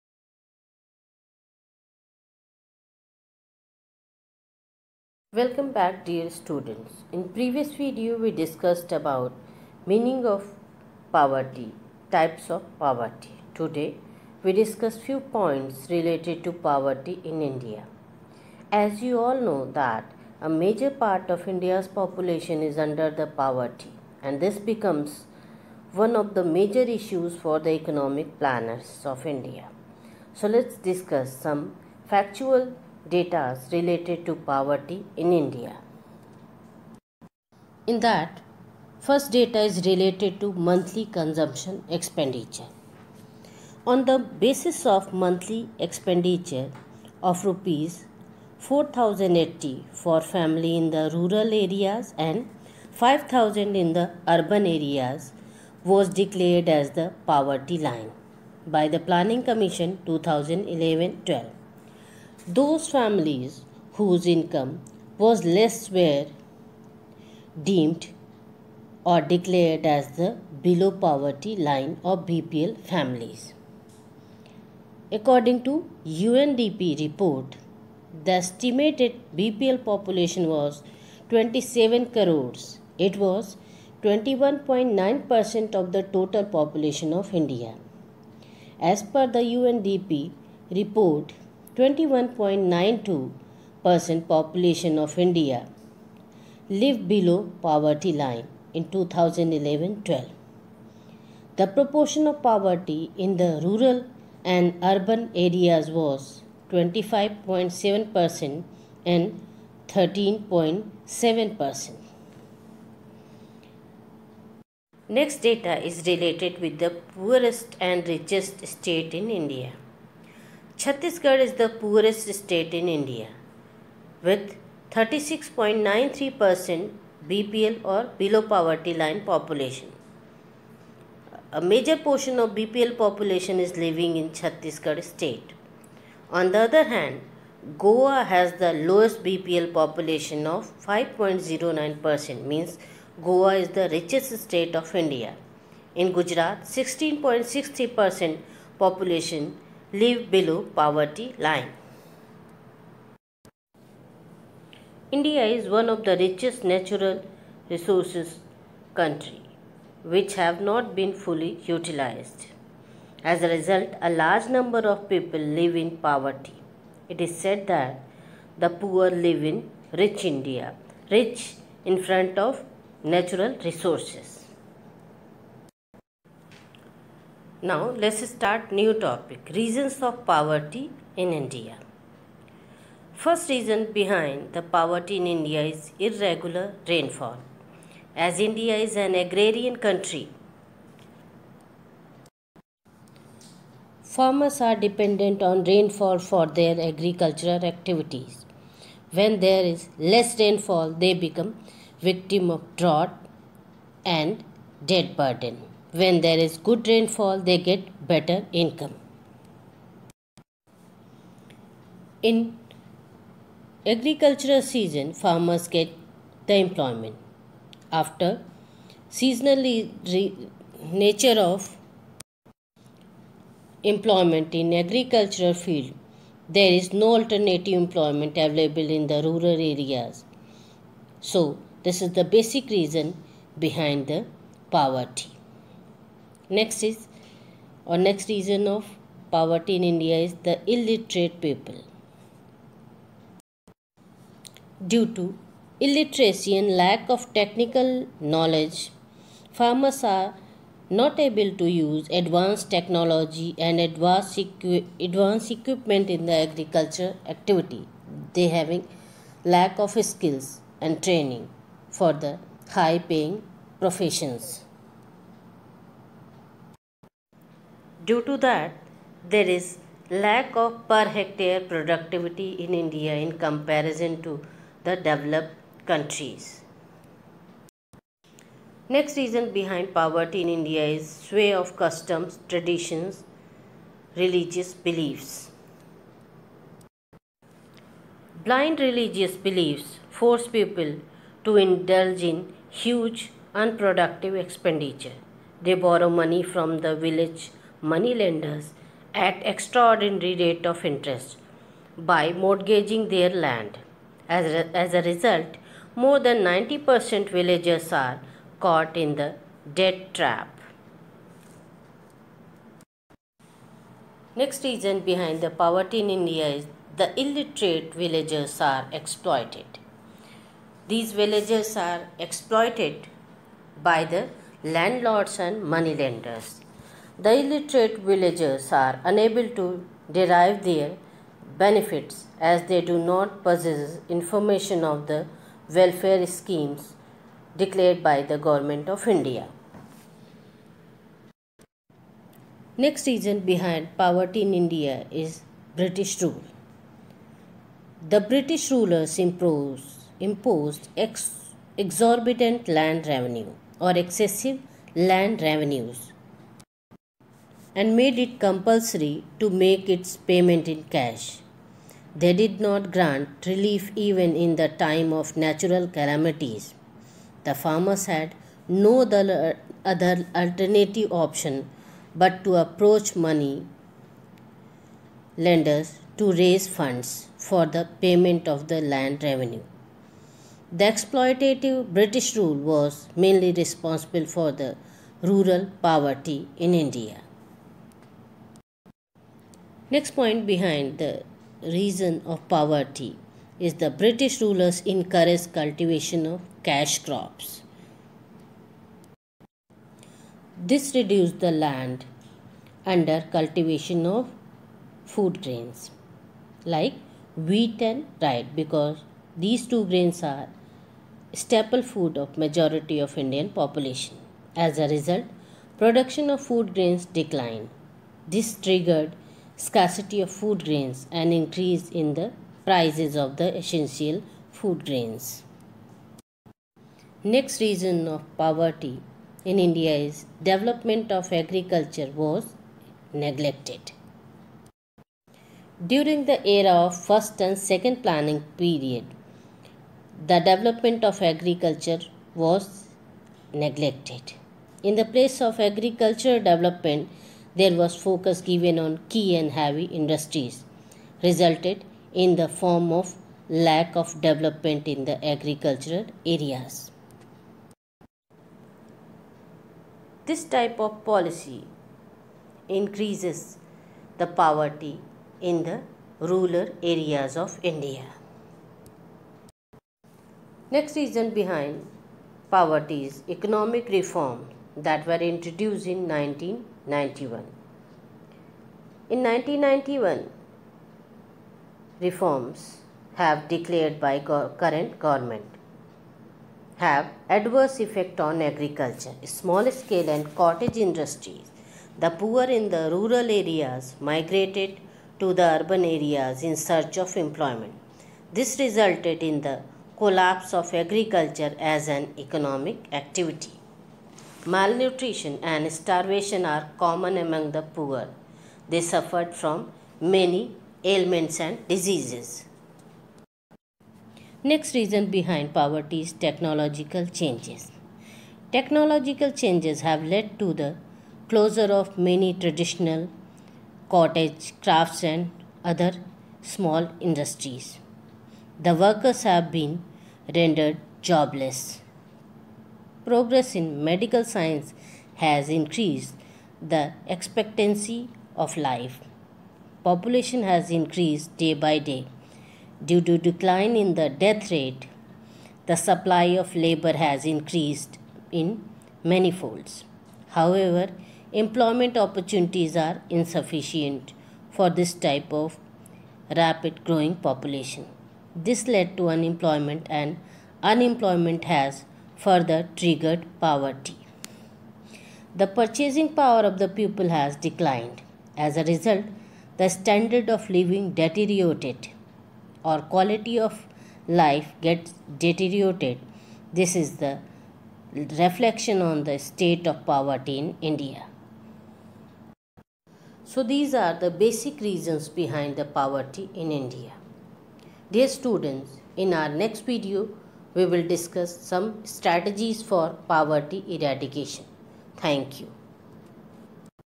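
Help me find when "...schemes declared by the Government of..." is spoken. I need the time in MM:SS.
05:36.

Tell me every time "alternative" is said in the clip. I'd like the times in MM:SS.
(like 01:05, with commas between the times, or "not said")
03:47, 06:10.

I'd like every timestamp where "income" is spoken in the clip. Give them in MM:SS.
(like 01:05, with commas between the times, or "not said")
01:04, 03:28.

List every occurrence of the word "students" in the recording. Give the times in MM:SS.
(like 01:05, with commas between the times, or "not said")
00:06, 09:48.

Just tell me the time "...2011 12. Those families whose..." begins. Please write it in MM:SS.
01:00.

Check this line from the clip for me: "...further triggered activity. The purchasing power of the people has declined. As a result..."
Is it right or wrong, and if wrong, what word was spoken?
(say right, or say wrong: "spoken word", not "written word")
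wrong: "poverty", not "activity".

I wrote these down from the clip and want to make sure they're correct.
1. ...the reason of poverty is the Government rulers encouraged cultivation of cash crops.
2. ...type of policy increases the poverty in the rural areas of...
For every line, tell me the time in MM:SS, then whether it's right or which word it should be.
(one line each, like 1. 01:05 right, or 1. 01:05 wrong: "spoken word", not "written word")
1. 06:30 wrong: "British", not "Government"
2. 07:40 right.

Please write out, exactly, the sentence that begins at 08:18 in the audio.
This resulted in the collapse of agriculture as an economic activity.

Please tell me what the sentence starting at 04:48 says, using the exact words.
Blind religious beliefs force people to indulge in huge unproductive expenditure.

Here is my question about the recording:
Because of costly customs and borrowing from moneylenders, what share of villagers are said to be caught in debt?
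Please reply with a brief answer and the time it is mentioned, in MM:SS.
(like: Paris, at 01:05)
More than 90%, at 05:05.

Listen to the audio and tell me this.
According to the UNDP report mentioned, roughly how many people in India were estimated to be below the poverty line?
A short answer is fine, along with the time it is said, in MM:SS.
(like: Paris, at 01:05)
27 crores, at 01:21.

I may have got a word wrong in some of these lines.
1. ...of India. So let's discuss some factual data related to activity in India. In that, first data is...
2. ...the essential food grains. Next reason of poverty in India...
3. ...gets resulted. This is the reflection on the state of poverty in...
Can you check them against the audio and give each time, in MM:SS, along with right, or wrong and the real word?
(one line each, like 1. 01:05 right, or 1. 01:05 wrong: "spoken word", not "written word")
1. 00:29 wrong: "poverty", not "activity"
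2. 07:03 right
3. 09:34 wrong: "deteriorated", not "resulted".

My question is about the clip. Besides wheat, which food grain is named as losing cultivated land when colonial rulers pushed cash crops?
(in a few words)
Rye.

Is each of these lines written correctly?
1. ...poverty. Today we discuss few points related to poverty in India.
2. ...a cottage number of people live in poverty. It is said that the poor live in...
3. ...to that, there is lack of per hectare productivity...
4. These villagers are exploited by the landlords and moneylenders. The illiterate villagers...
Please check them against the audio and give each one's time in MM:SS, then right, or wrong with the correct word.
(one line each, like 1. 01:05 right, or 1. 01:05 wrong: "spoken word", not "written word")
1. 00:12 right
2. 02:44 wrong: "large", not "cottage"
3. 04:28 right
4. 05:20 right.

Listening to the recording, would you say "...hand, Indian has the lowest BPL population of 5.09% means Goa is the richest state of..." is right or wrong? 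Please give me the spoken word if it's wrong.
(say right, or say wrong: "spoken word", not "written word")
wrong: "Goa", not "Indian".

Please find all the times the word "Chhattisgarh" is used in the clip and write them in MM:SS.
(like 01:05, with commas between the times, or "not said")
02:00, 02:14.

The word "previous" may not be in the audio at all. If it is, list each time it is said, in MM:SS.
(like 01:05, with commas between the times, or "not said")
00:07.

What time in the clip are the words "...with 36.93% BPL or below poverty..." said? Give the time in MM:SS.
02:04.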